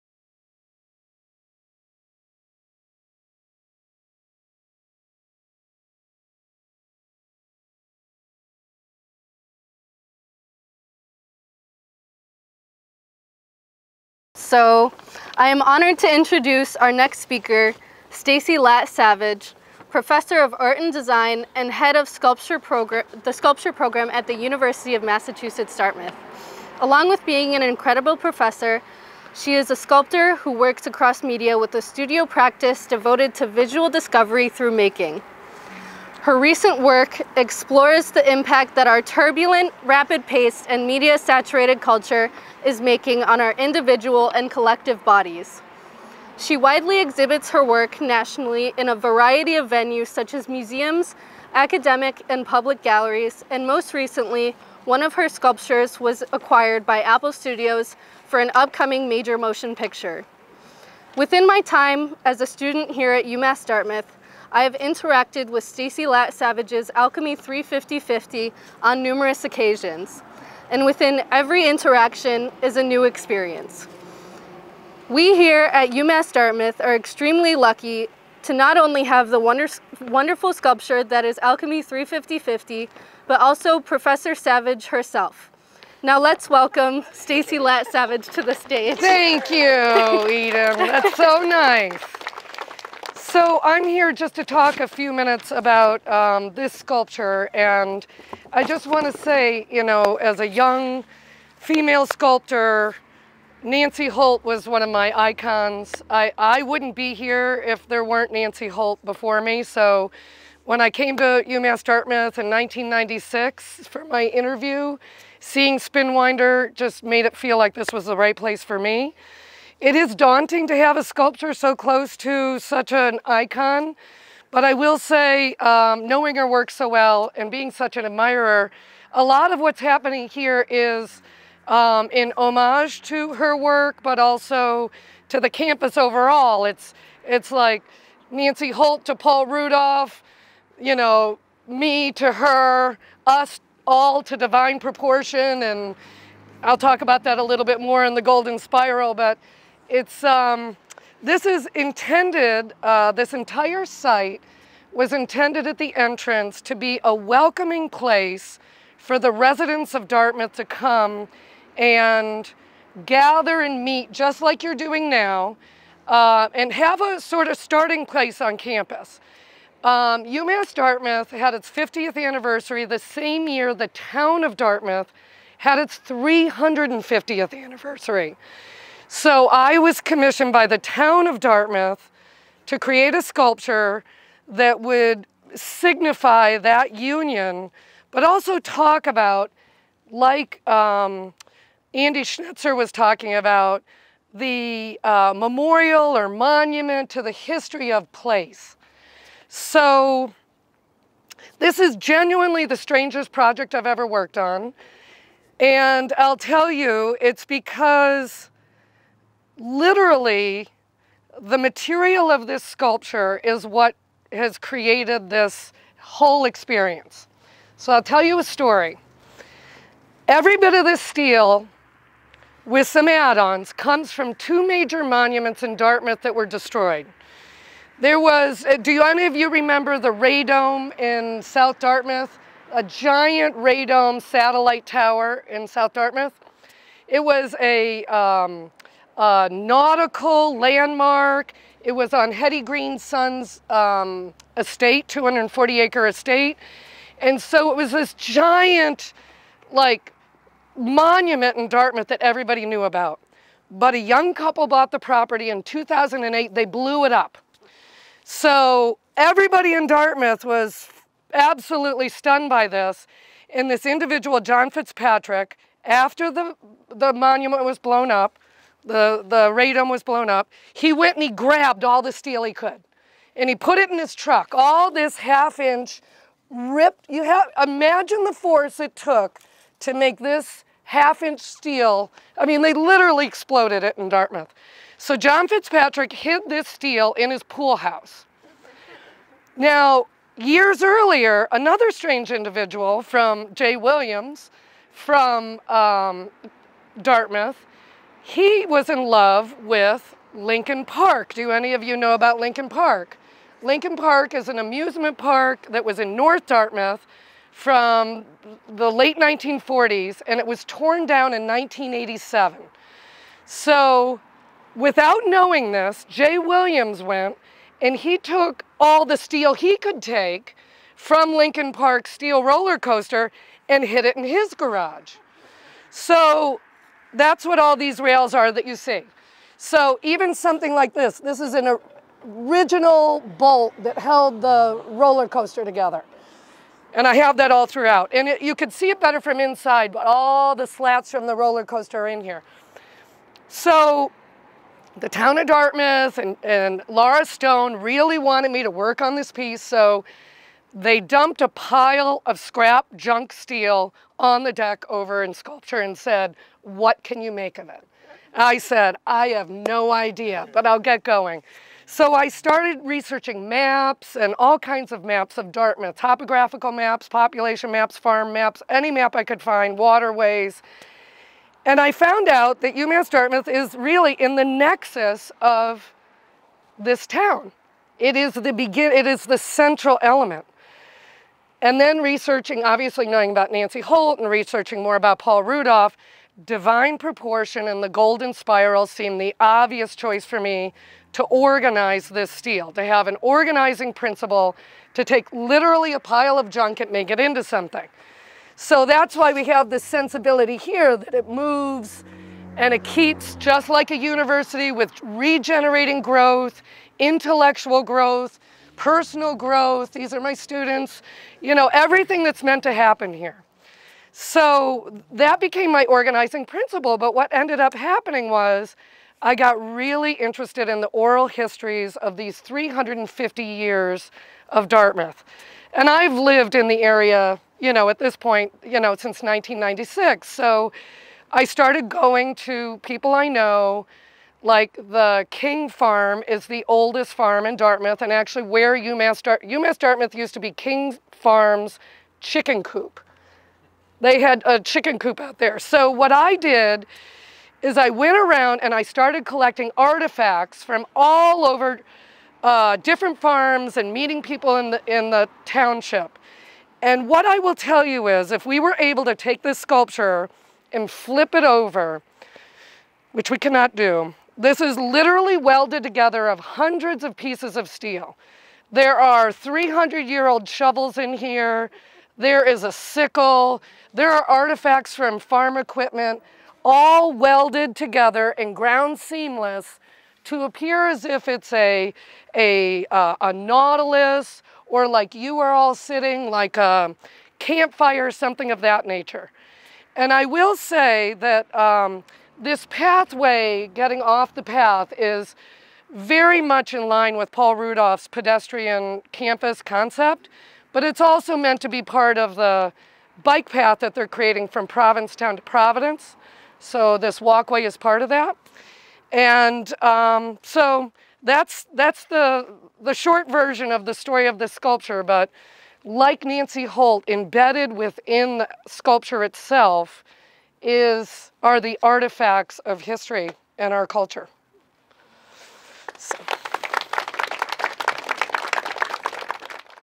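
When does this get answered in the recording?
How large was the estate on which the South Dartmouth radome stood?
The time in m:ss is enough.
4:05.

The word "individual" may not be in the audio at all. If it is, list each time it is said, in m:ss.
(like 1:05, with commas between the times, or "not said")
0:43, 4:23, 4:52.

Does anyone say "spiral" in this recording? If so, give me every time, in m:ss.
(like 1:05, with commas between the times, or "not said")
2:28, 6:28.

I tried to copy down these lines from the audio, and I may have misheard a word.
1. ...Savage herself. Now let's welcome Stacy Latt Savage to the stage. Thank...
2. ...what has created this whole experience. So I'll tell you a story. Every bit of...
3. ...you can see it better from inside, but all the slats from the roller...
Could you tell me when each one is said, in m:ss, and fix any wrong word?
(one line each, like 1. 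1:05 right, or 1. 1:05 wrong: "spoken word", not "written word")
1. 1:24 right
2. 3:33 right
3. 5:38 right.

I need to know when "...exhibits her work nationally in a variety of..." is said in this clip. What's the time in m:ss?
0:47.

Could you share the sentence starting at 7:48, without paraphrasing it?
There are 300 year old shovels in here.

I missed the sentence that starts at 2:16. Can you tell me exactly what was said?
It's, it's like Nancy Holt to Paul Rudolph, you know, me to her, us all to divine proportion.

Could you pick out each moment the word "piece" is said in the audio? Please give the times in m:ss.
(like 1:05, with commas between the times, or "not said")
5:49, 7:47.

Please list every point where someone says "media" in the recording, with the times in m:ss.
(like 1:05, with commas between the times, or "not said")
0:31, 0:40.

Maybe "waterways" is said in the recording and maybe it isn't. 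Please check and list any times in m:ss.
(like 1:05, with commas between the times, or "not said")
6:09.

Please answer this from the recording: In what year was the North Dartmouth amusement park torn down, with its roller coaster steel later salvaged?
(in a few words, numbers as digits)
1987.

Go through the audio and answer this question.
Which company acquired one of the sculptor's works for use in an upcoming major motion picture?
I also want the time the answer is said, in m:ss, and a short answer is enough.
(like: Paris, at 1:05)
Apple Studios, at 0:57.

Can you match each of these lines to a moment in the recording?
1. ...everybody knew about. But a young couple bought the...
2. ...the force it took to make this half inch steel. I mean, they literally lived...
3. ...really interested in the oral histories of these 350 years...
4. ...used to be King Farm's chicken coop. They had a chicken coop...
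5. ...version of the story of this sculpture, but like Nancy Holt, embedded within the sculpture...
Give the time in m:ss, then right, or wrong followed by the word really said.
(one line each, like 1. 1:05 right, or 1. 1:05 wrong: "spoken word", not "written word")
1. 4:12 right
2. 4:38 wrong: "exploded", not "lived"
3. 6:59 right
4. 7:20 right
5. 8:33 right.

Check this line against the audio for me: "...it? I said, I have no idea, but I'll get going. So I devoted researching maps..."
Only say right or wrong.
wrong.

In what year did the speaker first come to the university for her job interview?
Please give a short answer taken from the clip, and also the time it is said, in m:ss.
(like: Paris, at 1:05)
1996, at 1:52.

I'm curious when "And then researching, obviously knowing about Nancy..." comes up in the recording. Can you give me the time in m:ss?
6:21.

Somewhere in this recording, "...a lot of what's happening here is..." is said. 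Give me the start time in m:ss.
2:09.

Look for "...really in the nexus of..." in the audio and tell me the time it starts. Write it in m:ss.
6:13.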